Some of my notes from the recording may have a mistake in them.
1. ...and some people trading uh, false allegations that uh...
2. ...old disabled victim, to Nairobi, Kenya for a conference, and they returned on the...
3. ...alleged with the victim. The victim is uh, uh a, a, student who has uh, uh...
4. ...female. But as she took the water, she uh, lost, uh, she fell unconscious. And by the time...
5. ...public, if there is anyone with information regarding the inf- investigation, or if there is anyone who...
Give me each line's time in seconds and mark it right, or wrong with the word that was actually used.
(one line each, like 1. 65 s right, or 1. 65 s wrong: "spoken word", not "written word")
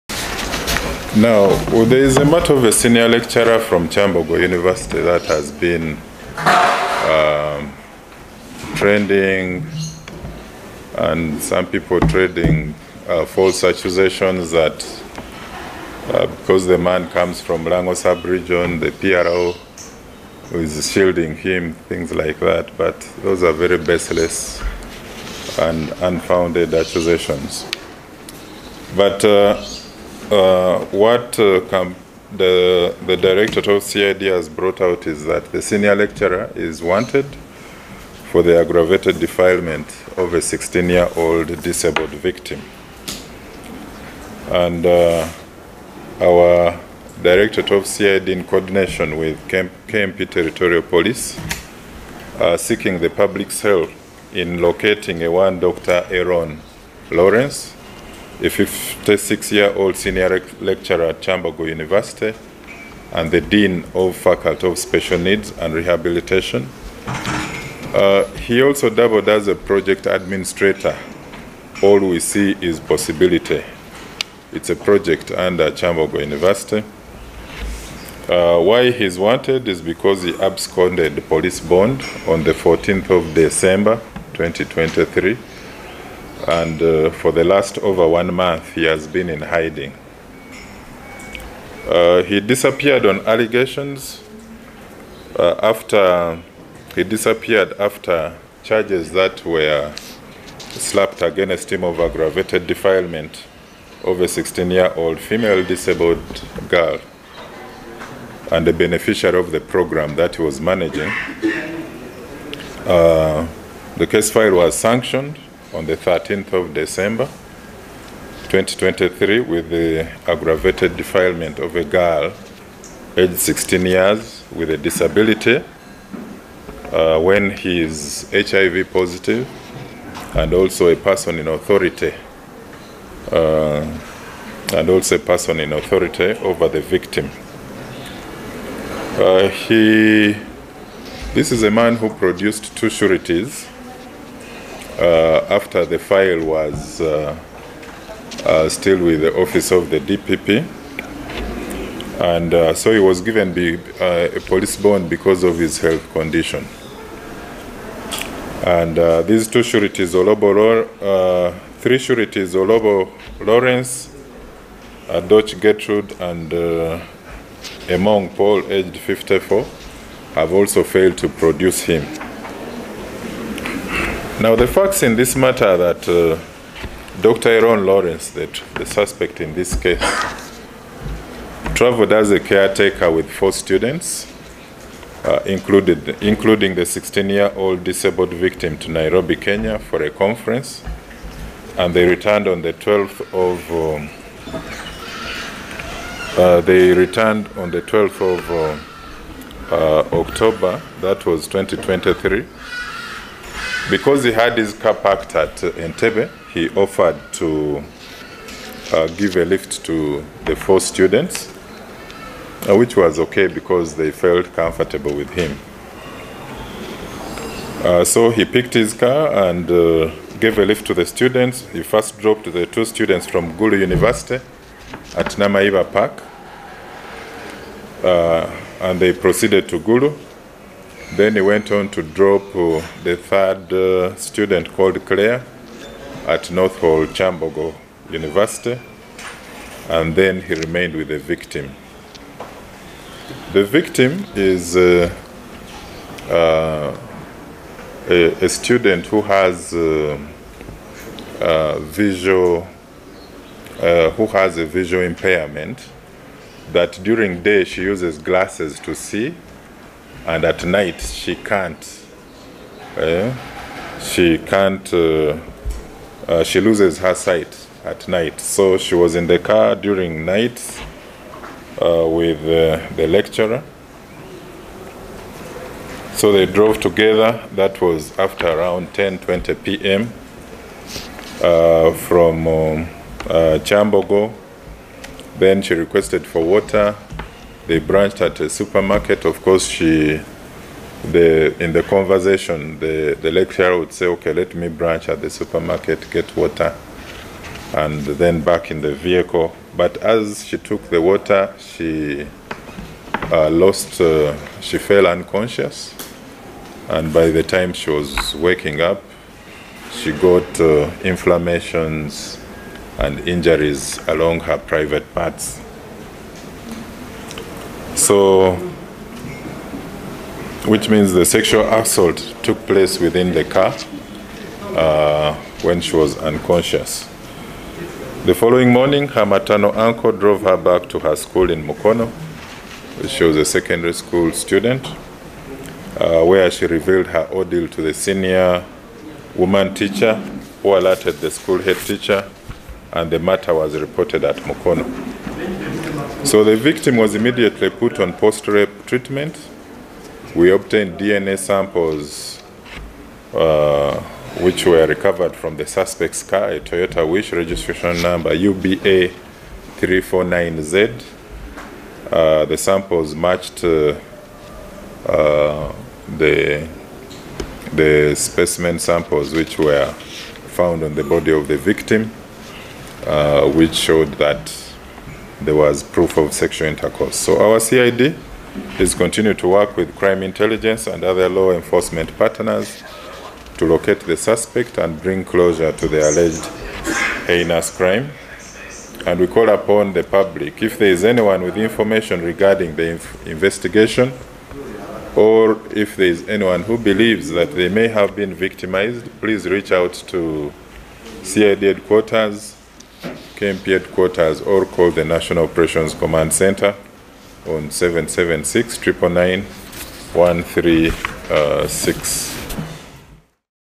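1. 10 s wrong: "accusations", not "allegations"
2. 187 s right
3. 240 s wrong: "remained", not "alleged"
4. 298 s wrong: "vehicle", not "female"
5. 390 s right.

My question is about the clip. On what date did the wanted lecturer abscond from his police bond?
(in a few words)
14 December 2023.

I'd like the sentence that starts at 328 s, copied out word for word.
The following morning, her maternal uncle drove her back to her school in Mukono.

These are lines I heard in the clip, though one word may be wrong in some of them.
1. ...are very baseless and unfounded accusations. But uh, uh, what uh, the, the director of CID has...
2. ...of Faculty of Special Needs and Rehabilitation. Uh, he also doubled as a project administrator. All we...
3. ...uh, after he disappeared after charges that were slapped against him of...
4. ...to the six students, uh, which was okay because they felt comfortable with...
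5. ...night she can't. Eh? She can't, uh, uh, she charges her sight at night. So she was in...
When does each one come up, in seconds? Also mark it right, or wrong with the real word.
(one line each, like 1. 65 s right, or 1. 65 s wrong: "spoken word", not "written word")
1. 23 s right
2. 63 s right
3. 95 s right
4. 209 s wrong: "four", not "six"
5. 260 s wrong: "loses", not "charges".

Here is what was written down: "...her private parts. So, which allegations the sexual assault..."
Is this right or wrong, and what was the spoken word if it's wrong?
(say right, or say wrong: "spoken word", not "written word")
wrong: "means", not "allegations".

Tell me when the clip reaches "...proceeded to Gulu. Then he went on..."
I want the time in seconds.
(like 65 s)
229 s.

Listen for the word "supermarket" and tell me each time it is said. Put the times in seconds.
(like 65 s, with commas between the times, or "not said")
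288 s, 295 s.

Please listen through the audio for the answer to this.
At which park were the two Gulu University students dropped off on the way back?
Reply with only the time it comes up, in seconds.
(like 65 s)
225 s.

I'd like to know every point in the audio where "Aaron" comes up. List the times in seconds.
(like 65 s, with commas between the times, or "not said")
56 s, 177 s.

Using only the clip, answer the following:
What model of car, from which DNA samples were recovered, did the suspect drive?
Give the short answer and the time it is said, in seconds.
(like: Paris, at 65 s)
Toyota Wish, at 356 s.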